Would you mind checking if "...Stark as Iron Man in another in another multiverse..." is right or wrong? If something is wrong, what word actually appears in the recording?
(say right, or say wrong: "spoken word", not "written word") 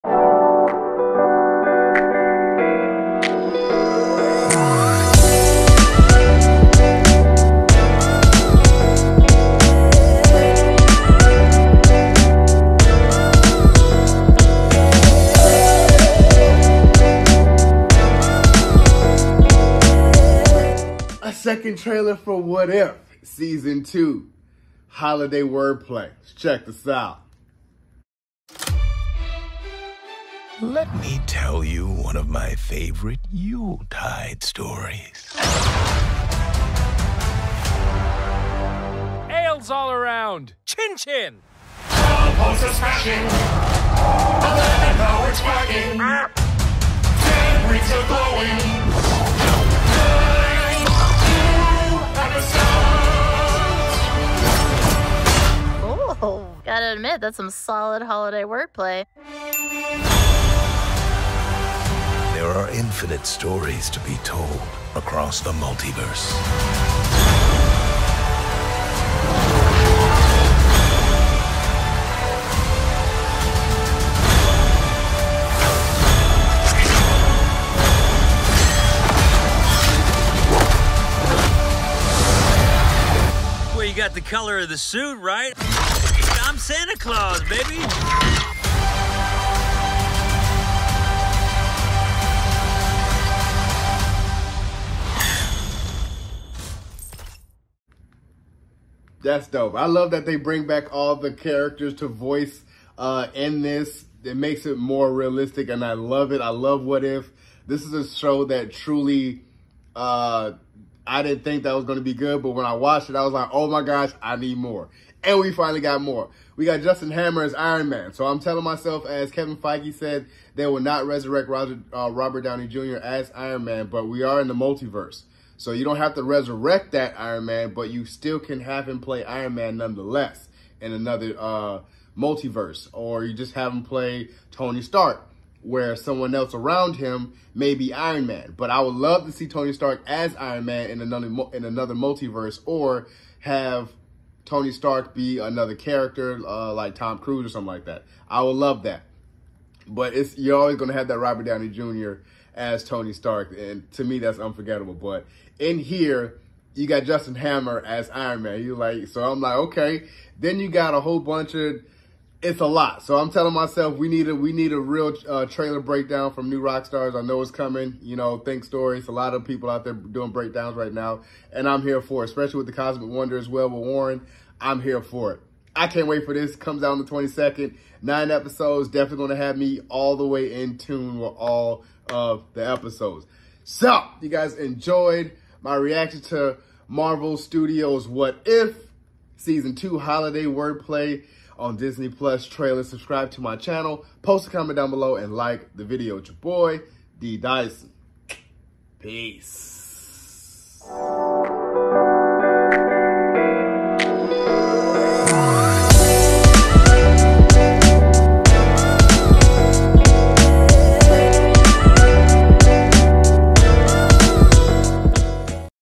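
right.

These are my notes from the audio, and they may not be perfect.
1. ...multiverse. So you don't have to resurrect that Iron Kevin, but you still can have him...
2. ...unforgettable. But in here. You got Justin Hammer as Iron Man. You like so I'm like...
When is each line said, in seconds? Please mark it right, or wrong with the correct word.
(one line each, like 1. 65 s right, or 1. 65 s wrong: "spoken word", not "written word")
1. 124 s wrong: "Man", not "Kevin"
2. 154 s right.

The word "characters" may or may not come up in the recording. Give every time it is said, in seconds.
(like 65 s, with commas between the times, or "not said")
101 s, 145 s.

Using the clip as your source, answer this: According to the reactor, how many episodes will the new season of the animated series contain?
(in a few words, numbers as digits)
9.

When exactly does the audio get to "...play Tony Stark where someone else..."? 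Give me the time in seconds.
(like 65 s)
133 s.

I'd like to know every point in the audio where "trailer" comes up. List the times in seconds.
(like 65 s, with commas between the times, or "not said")
21 s, 165 s, 192 s.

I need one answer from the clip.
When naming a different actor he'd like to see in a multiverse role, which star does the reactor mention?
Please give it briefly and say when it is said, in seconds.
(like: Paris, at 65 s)
Tom Cruise, at 146 s.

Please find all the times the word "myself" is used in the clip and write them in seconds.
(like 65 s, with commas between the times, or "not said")
118 s, 163 s.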